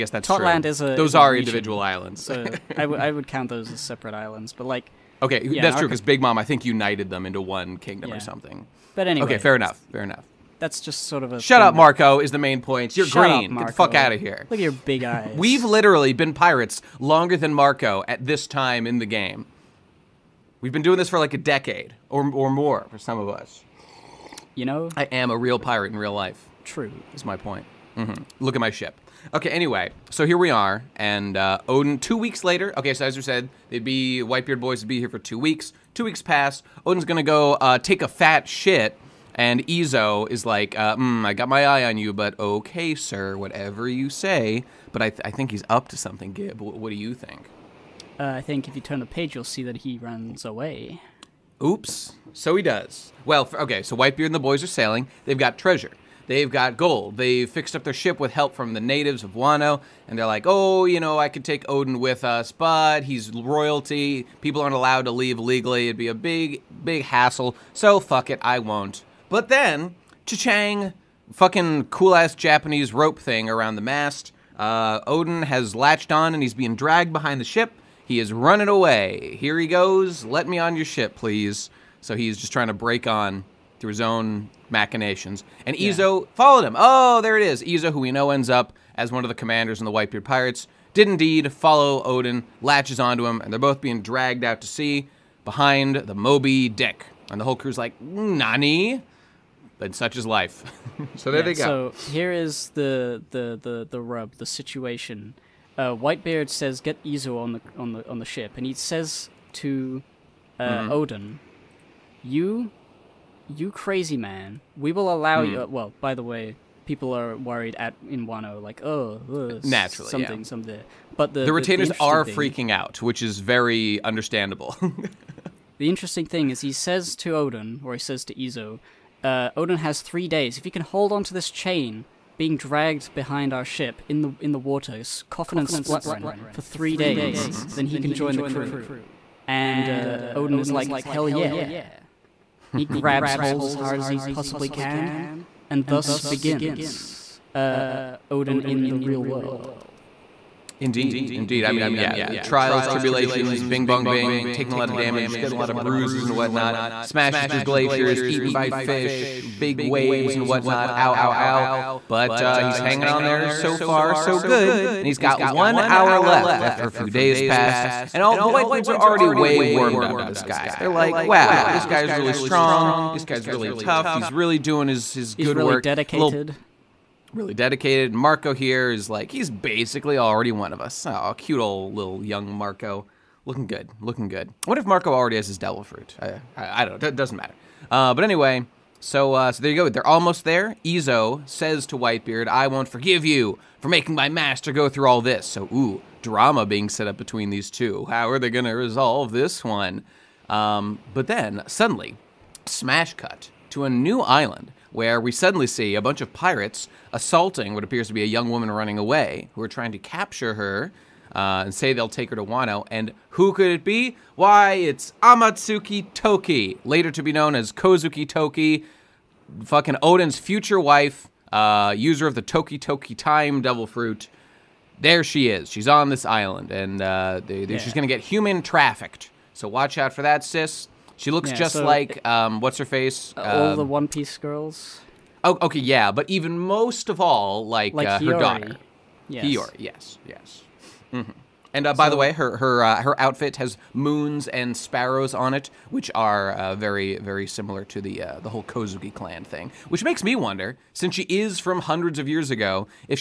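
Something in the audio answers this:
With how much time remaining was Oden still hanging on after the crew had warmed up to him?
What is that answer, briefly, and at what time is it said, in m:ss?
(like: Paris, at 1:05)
One hour, at 2:45.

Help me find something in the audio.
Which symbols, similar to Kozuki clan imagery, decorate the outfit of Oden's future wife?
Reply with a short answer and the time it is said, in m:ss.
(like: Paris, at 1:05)
Moons and sparrows, at 4:03.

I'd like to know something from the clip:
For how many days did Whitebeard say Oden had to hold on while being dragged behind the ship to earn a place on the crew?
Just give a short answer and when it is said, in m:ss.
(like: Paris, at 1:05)
3, at 2:10.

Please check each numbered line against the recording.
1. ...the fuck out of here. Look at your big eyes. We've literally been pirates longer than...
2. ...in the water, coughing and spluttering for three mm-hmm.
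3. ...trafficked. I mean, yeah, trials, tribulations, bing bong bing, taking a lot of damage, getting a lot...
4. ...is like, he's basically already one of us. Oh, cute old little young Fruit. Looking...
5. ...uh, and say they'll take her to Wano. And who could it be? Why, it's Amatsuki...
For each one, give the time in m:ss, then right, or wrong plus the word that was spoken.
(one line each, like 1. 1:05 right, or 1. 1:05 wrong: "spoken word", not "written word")
1. 0:13 right
2. 2:14 right
3. 2:31 wrong: "indeed", not "trafficked"
4. 2:58 wrong: "Marco", not "Fruit"
5. 3:31 right.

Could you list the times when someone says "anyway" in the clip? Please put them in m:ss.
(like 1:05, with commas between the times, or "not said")
0:09, 0:29, 3:08.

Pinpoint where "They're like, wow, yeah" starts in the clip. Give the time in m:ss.
2:50.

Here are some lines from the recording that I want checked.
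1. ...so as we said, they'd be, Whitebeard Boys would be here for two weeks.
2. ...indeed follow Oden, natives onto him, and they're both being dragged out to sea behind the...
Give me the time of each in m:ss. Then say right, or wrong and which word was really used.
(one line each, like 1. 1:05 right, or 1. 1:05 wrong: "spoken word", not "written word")
1. 0:32 right
2. 1:31 wrong: "latches", not "natives".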